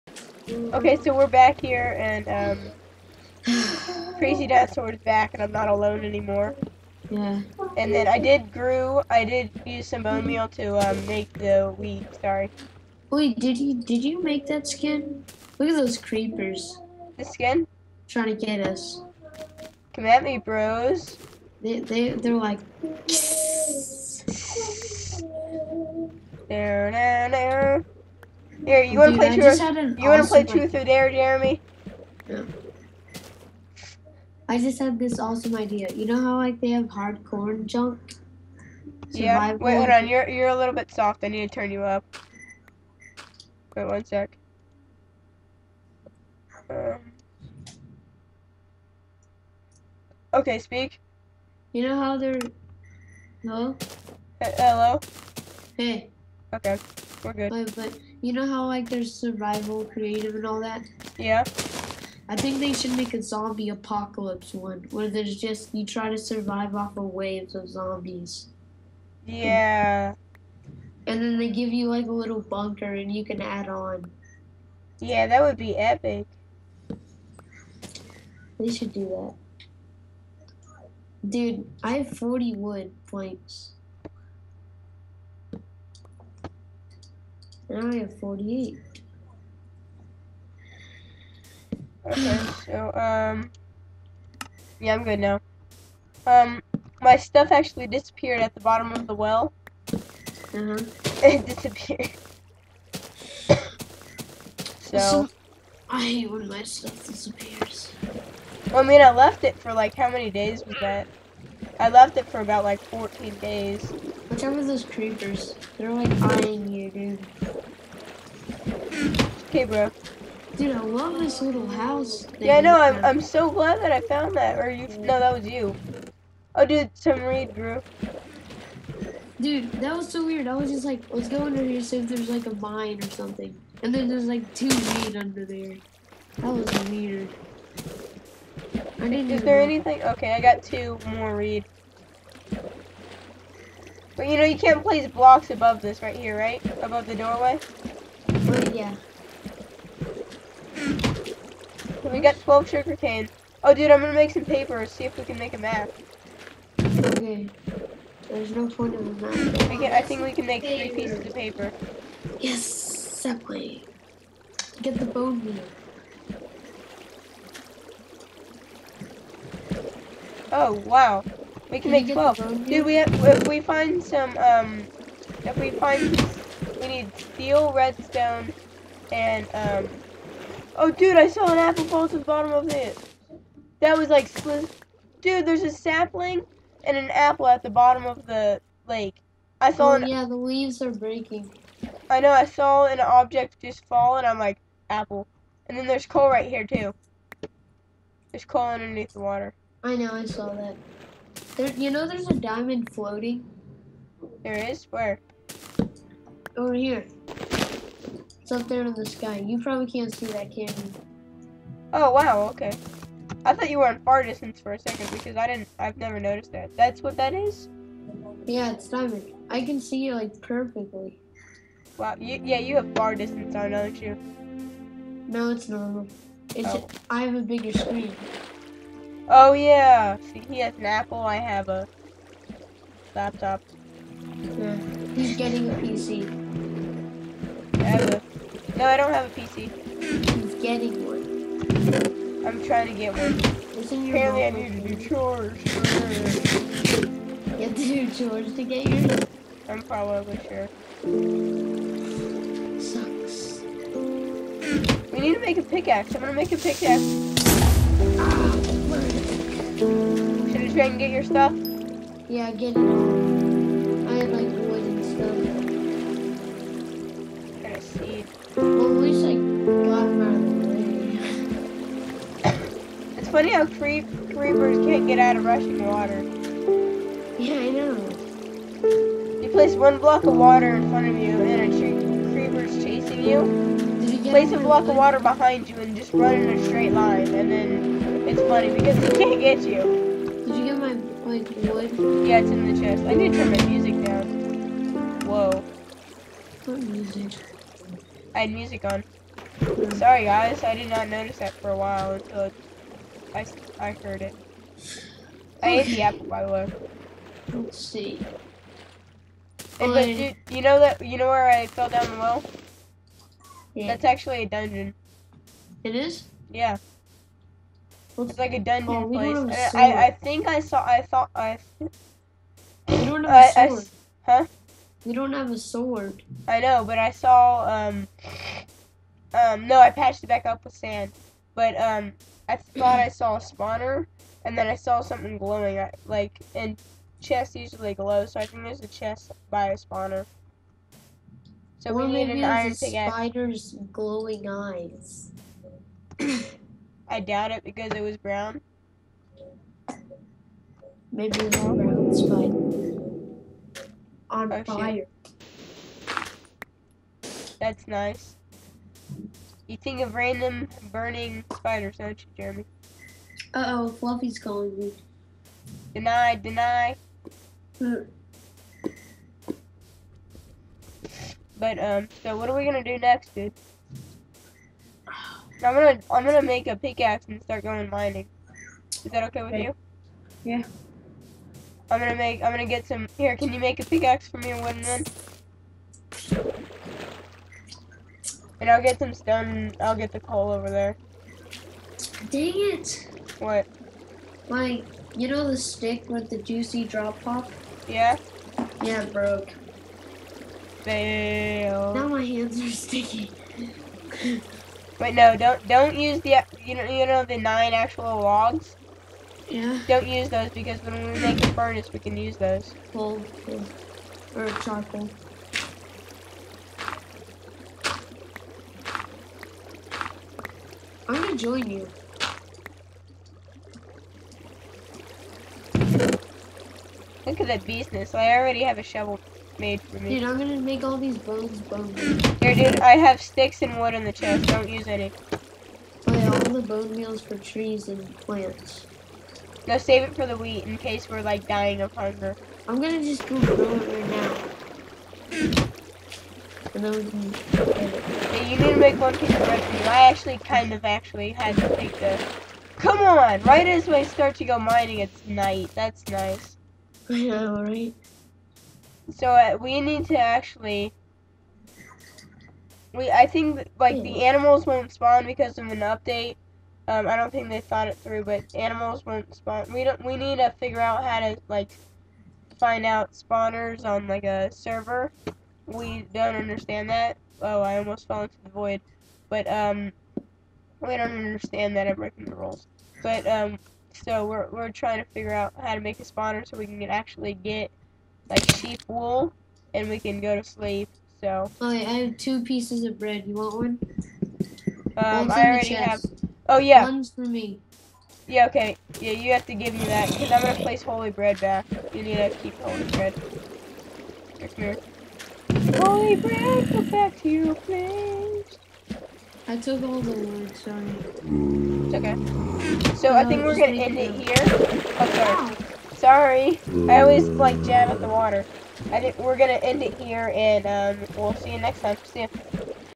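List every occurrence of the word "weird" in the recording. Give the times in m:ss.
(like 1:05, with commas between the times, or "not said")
2:10, 2:16.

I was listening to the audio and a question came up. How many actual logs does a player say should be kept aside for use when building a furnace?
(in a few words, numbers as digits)
9.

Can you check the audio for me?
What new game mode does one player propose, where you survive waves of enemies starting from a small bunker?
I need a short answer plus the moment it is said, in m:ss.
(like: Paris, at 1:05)
Zombie apocalypse, at 1:03.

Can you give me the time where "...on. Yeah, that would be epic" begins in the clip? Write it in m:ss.
1:13.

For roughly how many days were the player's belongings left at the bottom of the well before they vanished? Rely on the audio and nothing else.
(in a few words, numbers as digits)
14.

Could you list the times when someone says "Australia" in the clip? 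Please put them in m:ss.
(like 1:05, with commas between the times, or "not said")
not said.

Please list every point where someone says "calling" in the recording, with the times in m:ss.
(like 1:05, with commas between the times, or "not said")
6:04.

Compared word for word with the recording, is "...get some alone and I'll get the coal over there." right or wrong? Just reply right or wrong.
wrong.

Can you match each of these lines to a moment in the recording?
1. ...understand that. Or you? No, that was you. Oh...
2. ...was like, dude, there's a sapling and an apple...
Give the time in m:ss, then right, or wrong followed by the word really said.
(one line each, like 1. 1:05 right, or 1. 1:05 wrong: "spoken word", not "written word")
1. 2:04 wrong: "found", not "understand"
2. 3:03 right.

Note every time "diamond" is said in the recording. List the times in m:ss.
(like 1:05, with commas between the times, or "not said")
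3:22, 3:38.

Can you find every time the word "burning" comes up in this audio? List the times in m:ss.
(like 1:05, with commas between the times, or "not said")
6:00.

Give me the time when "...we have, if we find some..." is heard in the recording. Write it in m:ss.
2:52.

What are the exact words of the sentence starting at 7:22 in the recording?
I'm gonna just go grow it right now.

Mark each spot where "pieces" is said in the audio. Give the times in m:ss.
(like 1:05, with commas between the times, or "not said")
2:40, 7:29, 8:12.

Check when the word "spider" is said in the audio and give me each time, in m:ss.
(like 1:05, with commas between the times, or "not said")
5:43, 6:01.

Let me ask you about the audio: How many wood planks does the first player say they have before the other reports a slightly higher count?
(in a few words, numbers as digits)
40.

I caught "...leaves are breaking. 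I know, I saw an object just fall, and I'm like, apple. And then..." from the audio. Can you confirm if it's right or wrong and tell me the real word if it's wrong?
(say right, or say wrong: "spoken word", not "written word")
right.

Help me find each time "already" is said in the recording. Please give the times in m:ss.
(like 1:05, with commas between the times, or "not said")
7:08, 8:15.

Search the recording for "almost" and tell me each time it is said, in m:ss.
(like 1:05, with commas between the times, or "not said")
7:57.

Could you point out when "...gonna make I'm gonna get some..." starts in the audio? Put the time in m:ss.
6:21.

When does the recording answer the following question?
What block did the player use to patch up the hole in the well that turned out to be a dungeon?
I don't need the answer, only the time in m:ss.
5:30.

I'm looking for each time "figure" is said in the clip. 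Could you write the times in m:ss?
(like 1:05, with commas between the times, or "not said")
7:50, 8:05.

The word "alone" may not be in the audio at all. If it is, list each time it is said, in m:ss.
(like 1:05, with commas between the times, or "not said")
0:05.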